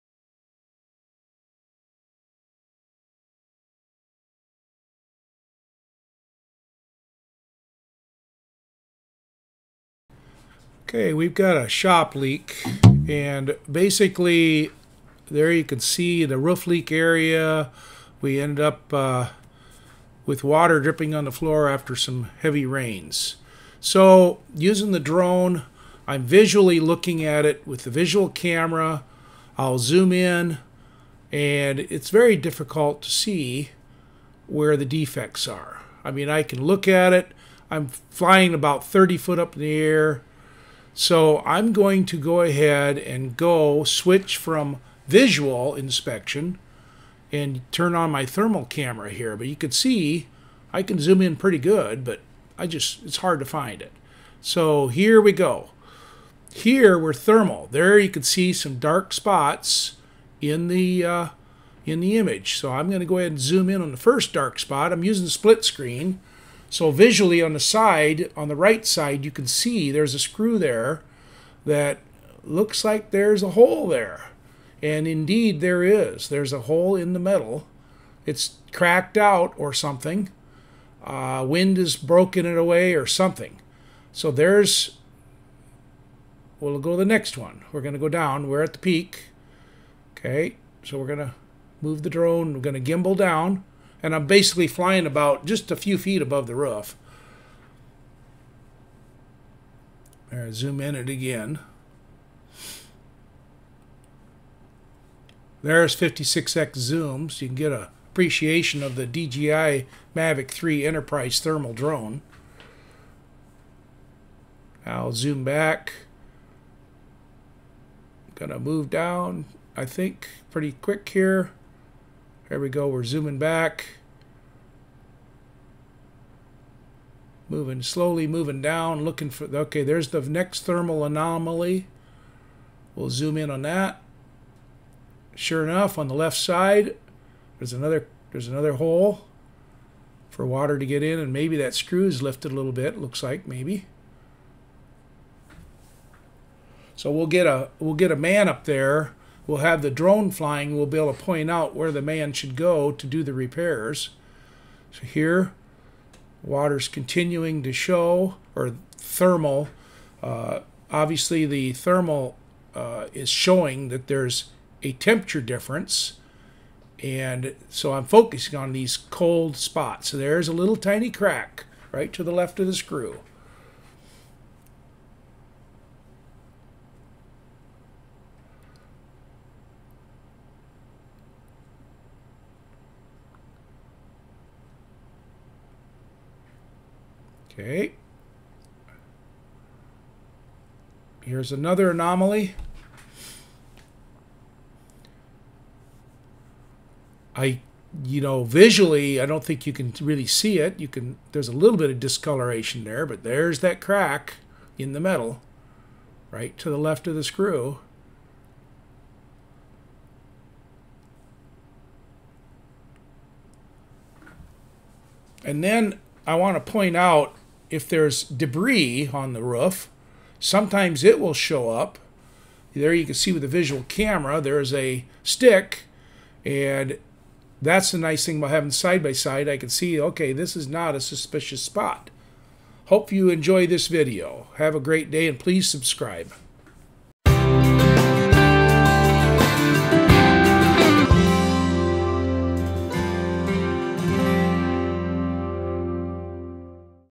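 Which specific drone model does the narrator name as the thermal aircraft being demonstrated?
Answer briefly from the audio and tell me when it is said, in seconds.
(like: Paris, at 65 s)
DJI Mavic 3 Enterprise, at 109 s.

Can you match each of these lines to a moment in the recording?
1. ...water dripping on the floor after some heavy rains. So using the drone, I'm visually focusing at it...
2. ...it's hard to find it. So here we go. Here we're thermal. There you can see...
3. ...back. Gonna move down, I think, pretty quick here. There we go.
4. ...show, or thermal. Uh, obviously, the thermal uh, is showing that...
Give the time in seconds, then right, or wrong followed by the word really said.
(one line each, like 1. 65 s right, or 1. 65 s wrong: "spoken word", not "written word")
1. 20 s wrong: "looking", not "focusing"
2. 53 s right
3. 115 s right
4. 157 s right.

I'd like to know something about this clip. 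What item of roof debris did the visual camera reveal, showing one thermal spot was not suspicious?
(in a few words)
a stick.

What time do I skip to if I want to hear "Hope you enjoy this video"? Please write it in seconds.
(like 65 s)
232 s.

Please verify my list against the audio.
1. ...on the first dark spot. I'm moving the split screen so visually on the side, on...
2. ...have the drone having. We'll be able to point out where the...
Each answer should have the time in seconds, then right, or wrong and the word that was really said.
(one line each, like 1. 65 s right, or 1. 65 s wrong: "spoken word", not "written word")
1. 63 s wrong: "using", not "moving"
2. 149 s wrong: "flying", not "having".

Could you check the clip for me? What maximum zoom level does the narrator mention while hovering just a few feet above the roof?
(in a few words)
56x.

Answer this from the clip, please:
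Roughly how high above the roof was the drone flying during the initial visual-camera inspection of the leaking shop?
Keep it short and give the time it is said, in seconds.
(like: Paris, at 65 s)
30 feet, at 38 s.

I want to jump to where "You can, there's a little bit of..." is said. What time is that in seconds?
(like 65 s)
200 s.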